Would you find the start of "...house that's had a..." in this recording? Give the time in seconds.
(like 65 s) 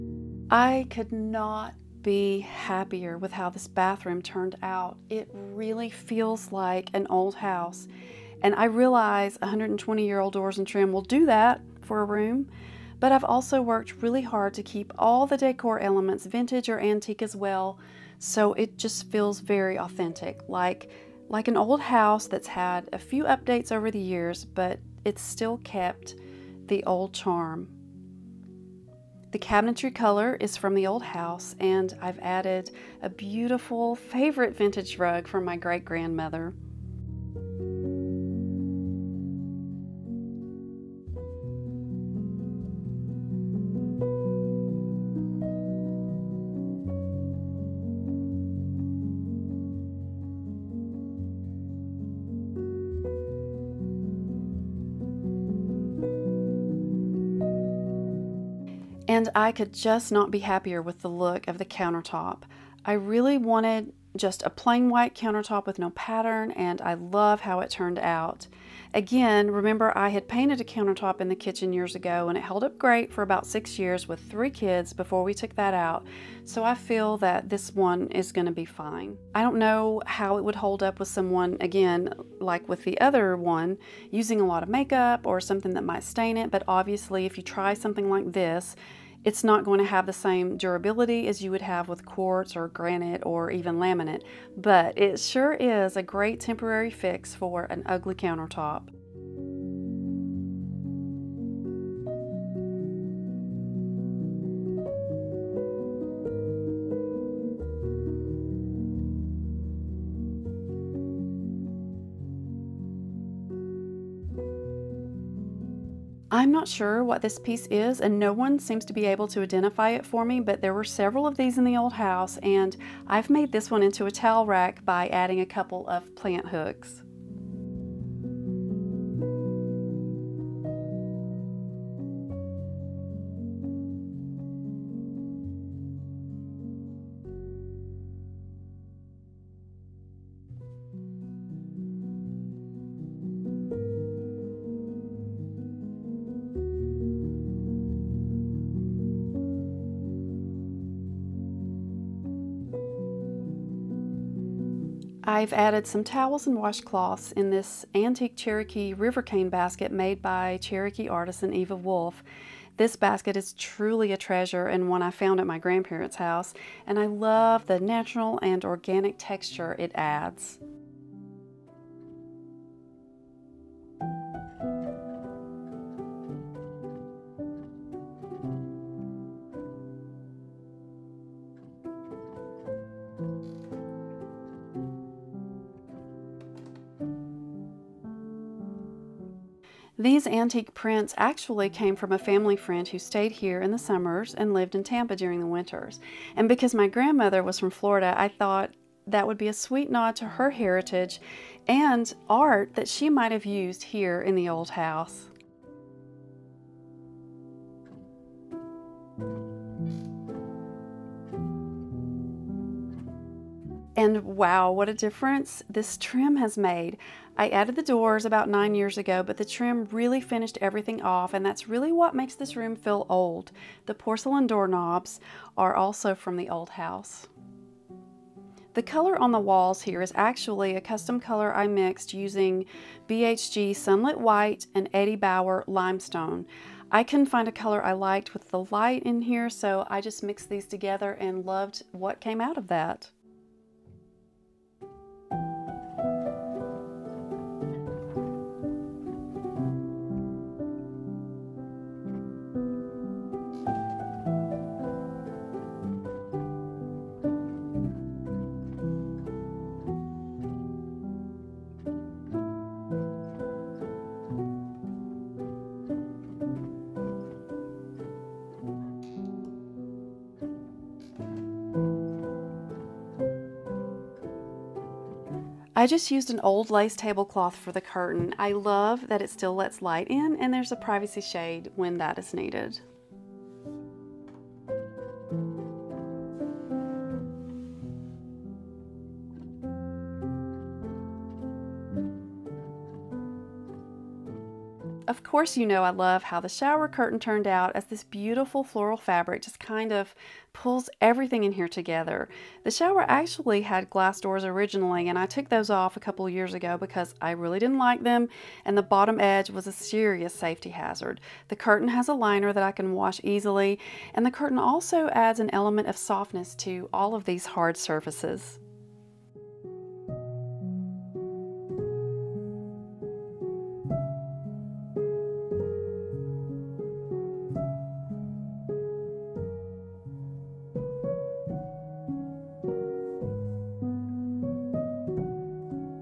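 21 s.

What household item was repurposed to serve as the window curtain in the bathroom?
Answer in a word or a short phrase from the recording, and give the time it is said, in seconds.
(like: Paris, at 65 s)
old lace tablecloth, at 276 s.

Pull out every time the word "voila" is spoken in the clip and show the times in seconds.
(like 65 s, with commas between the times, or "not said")
not said.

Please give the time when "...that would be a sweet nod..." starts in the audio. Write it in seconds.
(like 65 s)
199 s.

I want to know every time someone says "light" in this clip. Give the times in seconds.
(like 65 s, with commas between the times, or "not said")
238 s, 279 s.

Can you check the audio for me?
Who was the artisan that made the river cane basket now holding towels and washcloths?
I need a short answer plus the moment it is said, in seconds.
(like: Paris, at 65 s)
Eva Wolfe, at 161 s.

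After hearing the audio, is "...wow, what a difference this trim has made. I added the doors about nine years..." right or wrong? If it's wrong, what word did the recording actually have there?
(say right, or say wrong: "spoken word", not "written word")
right.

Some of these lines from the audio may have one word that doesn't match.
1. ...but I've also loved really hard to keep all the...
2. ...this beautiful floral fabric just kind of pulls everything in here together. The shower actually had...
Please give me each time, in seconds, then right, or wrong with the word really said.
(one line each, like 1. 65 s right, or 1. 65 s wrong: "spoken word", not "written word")
1. 12 s wrong: "worked", not "loved"
2. 297 s right.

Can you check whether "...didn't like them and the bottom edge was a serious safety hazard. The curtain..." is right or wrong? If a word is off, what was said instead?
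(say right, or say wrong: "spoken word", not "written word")
right.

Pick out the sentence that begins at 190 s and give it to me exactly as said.
These antique prints actually came from a family friend who stayed here in the summers and lived in Tampa during the winters.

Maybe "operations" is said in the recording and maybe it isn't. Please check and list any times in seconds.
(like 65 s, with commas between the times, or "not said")
not said.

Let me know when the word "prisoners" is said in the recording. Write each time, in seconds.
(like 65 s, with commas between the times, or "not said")
not said.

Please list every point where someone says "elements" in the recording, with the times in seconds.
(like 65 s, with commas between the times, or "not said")
15 s, 315 s.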